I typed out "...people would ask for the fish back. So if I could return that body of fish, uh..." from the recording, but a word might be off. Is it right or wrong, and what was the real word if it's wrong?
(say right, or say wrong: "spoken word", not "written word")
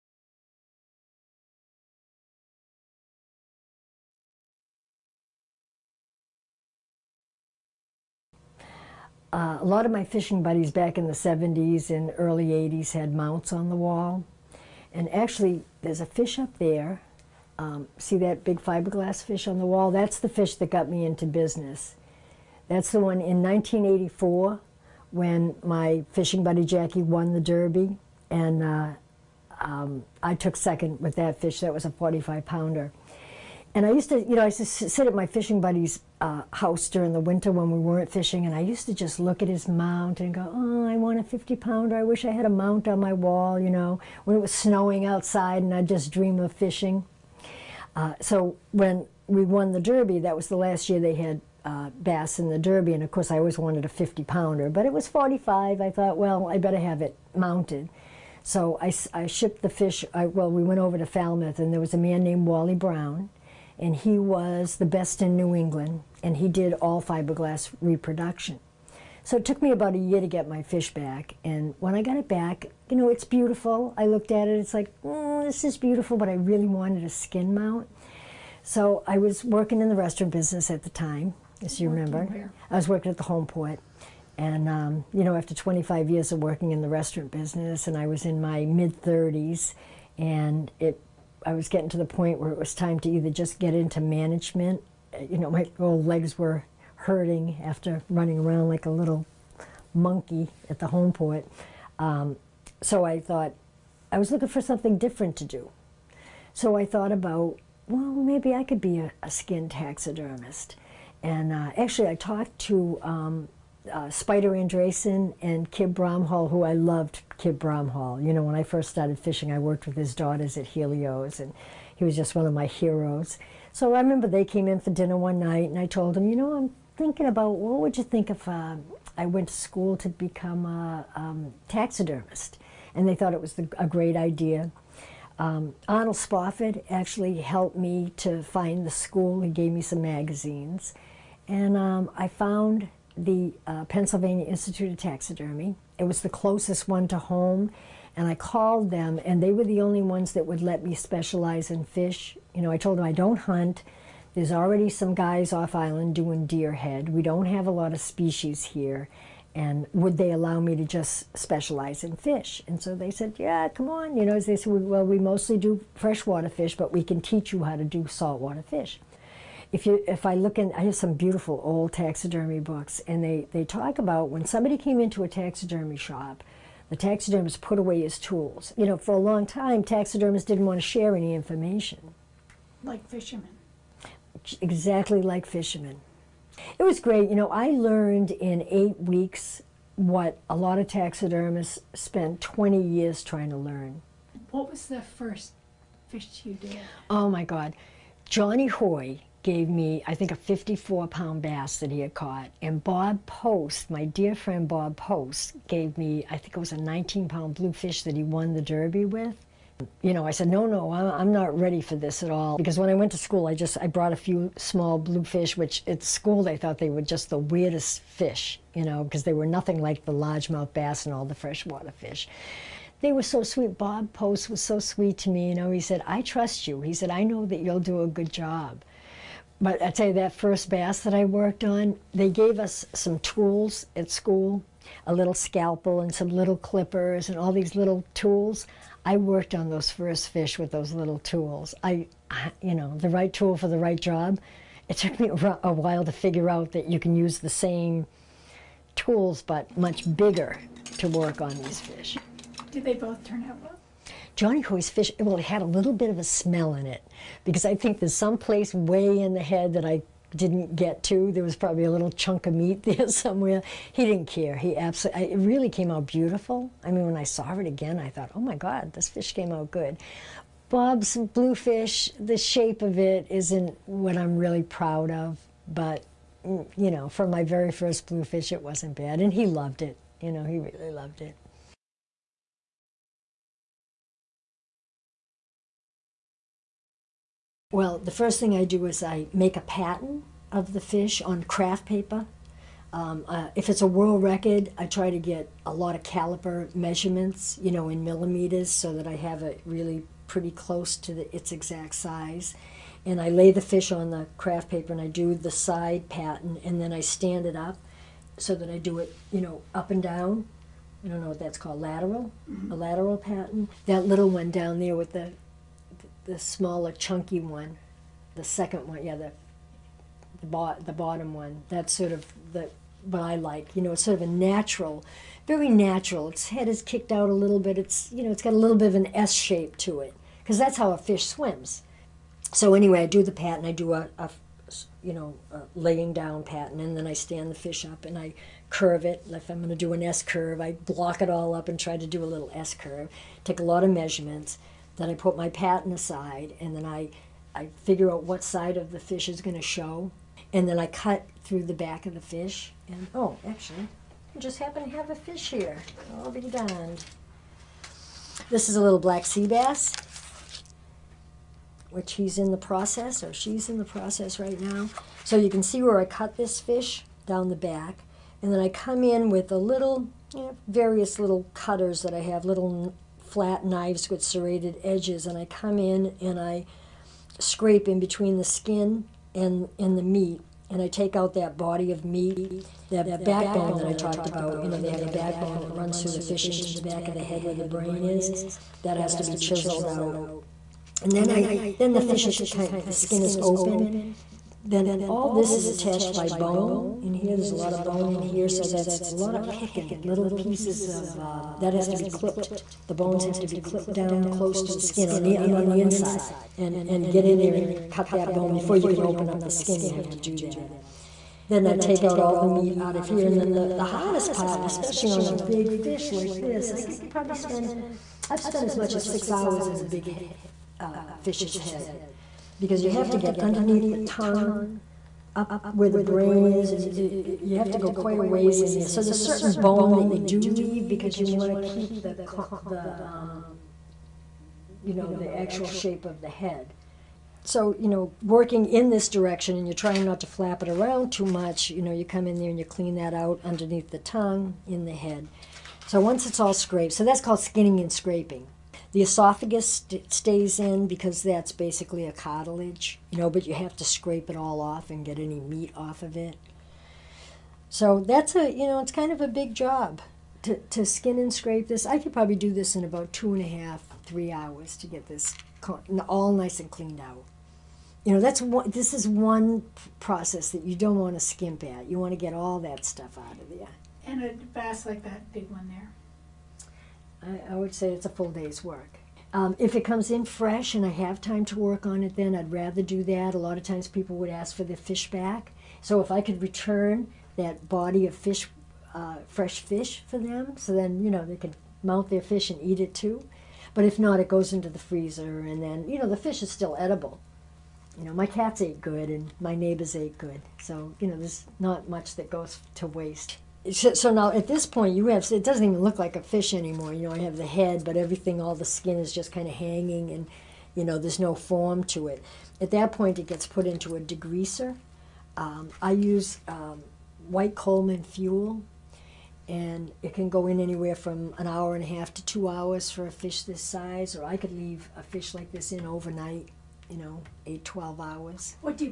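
right.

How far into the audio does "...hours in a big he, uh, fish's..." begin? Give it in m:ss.
6:59.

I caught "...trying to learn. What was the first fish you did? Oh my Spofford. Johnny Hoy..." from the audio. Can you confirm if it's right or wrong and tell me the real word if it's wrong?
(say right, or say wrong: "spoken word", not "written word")
wrong: "God", not "Spofford".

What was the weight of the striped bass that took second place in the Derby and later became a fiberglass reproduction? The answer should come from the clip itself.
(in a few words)
45 pounds.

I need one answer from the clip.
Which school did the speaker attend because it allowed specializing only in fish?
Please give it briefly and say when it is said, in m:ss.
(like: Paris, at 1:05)
Pennsylvania Institute of Taxidermy, at 2:23.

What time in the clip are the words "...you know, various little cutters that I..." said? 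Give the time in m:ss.
6:10.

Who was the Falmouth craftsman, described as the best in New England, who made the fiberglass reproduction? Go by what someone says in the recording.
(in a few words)
Wally Brown.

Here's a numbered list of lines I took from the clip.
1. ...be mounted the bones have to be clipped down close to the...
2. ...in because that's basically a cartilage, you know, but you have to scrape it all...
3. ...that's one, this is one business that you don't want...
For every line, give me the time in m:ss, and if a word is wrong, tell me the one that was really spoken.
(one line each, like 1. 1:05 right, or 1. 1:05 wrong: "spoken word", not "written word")
1. 6:41 wrong: "clipped", not "mounted"
2. 7:30 right
3. 7:48 wrong: "process", not "business".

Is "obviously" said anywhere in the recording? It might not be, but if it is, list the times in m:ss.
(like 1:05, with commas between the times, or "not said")
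not said.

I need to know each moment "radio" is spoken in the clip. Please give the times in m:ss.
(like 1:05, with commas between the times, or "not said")
not said.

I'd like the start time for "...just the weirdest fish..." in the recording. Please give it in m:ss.
3:37.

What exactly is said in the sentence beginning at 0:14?
And actually, there's a fish up there.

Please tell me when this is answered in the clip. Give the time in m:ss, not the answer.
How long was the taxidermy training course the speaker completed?
3:08.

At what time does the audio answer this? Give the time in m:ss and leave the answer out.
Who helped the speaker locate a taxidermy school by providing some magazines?
2:15.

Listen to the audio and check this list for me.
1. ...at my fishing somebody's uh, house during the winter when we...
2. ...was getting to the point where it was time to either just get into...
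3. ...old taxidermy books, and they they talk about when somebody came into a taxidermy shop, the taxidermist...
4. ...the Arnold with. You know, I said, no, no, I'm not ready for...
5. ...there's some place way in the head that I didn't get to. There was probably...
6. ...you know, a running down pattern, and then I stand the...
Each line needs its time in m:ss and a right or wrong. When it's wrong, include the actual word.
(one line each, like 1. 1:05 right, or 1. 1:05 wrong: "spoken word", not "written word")
1. 0:35 wrong: "buddy", not "somebody"
2. 1:31 right
3. 2:51 right
4. 3:28 wrong: "Derby", not "Arnold"
5. 4:17 right
6. 5:35 wrong: "laying", not "running".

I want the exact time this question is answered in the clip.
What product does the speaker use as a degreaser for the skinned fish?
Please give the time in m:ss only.
8:37.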